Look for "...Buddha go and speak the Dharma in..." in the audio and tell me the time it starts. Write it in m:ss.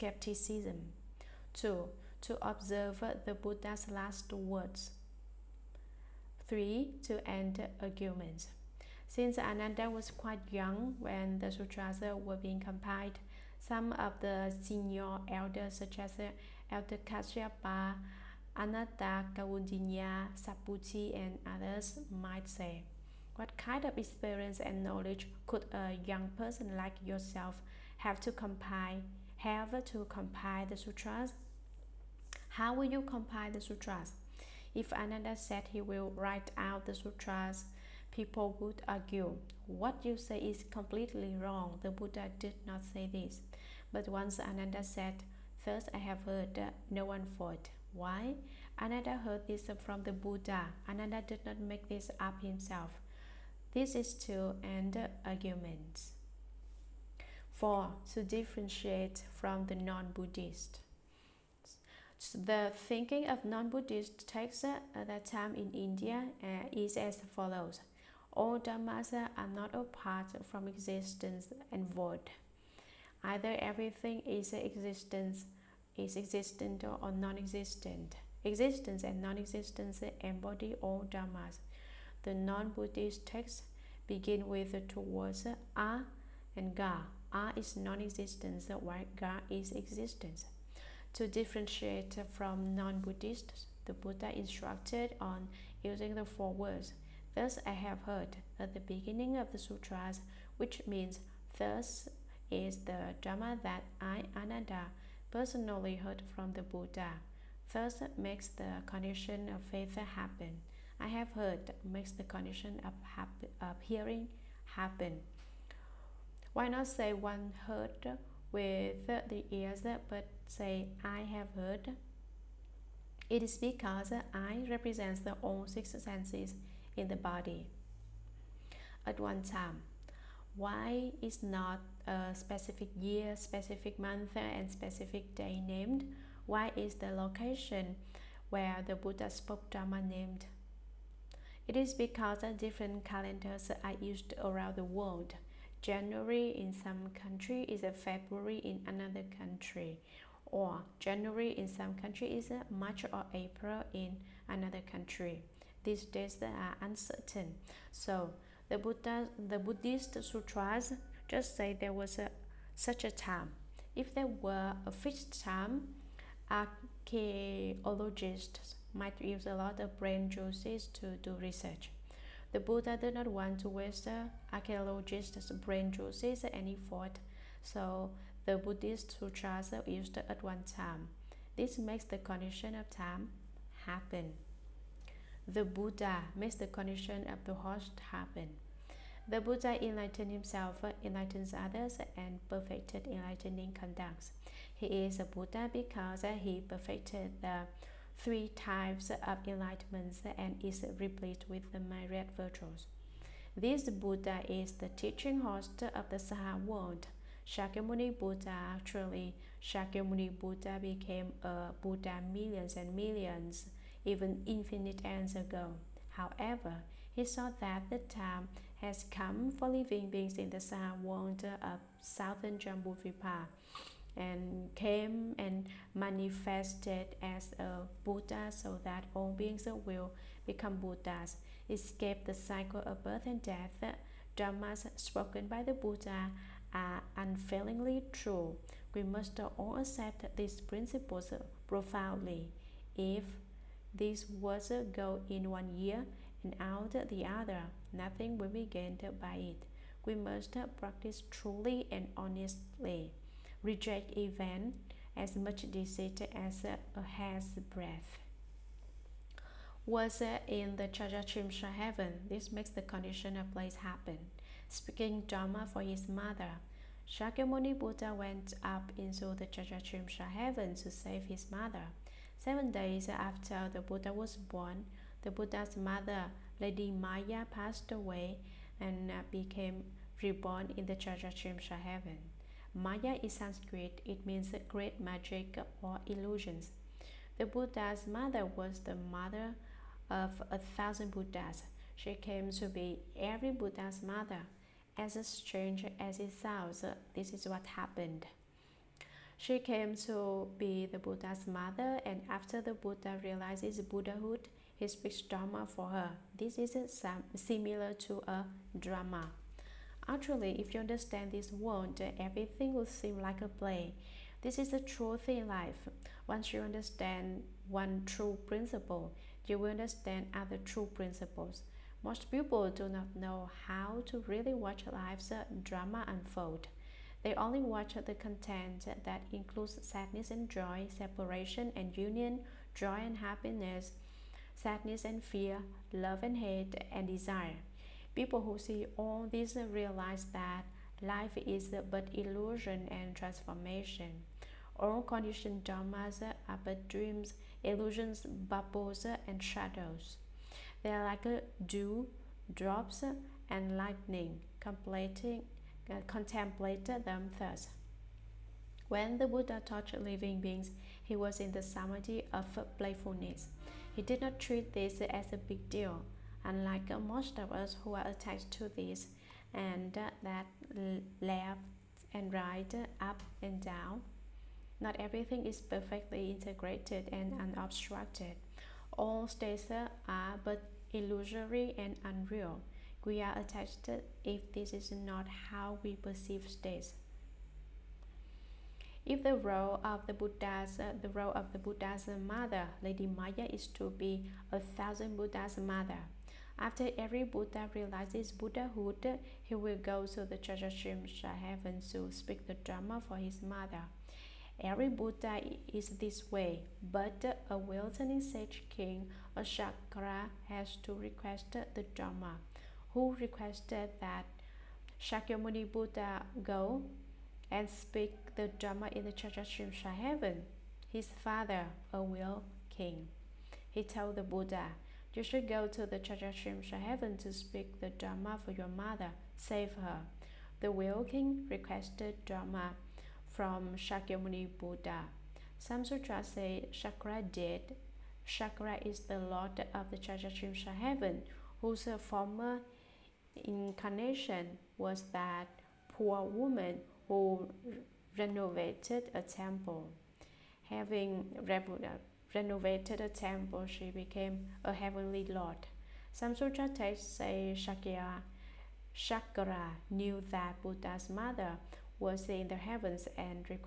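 6:55.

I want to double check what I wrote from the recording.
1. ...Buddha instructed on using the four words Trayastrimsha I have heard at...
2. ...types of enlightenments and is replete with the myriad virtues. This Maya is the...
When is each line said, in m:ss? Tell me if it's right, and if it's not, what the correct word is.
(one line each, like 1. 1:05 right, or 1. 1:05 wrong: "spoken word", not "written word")
1. 1:33 wrong: "Thus", not "Trayastrimsha"
2. 3:18 wrong: "Buddha", not "Maya".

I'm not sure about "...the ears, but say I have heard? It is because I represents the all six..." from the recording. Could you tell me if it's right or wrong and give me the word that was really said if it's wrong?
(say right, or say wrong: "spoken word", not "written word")
right.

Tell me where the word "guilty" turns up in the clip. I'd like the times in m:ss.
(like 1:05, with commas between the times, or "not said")
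not said.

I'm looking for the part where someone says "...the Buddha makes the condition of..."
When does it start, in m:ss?
3:05.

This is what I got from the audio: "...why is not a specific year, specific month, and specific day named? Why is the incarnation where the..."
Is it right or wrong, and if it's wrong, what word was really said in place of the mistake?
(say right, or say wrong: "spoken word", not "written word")
wrong: "location", not "incarnation".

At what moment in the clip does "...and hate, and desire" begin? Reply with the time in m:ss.
5:36.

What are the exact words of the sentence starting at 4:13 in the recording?
Reject even as much deceit as a uh, hair's breath.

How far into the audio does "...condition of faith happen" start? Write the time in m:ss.
1:48.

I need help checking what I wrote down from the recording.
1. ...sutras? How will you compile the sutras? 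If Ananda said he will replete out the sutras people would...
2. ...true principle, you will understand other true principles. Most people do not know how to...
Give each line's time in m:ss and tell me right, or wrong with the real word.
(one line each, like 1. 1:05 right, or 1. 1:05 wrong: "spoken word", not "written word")
1. 0:30 wrong: "write", not "replete"
2. 5:18 right.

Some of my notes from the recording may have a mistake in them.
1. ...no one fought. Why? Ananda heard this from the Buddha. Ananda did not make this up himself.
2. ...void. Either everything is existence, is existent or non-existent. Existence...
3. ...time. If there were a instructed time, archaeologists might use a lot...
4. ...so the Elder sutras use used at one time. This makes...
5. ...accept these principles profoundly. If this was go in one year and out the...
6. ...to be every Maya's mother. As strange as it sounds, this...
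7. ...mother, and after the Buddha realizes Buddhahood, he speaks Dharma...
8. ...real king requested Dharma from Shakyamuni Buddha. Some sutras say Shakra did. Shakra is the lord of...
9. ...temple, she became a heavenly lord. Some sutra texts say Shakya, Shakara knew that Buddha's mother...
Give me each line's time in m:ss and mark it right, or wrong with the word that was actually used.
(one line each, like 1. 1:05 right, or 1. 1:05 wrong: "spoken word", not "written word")
1. 0:46 right
2. 1:11 right
3. 2:43 wrong: "fixed", not "instructed"
4. 2:57 wrong: "Buddhist", not "Elder"
5. 3:59 right
6. 4:52 wrong: "Buddha", not "Maya"
7. 5:01 right
8. 7:10 right
9. 7:33 right.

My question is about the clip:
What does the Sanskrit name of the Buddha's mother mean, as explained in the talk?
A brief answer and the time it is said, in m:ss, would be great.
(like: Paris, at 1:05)
Great magic or illusions, at 4:44.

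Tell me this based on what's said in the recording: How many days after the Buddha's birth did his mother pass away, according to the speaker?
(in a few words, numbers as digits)
7.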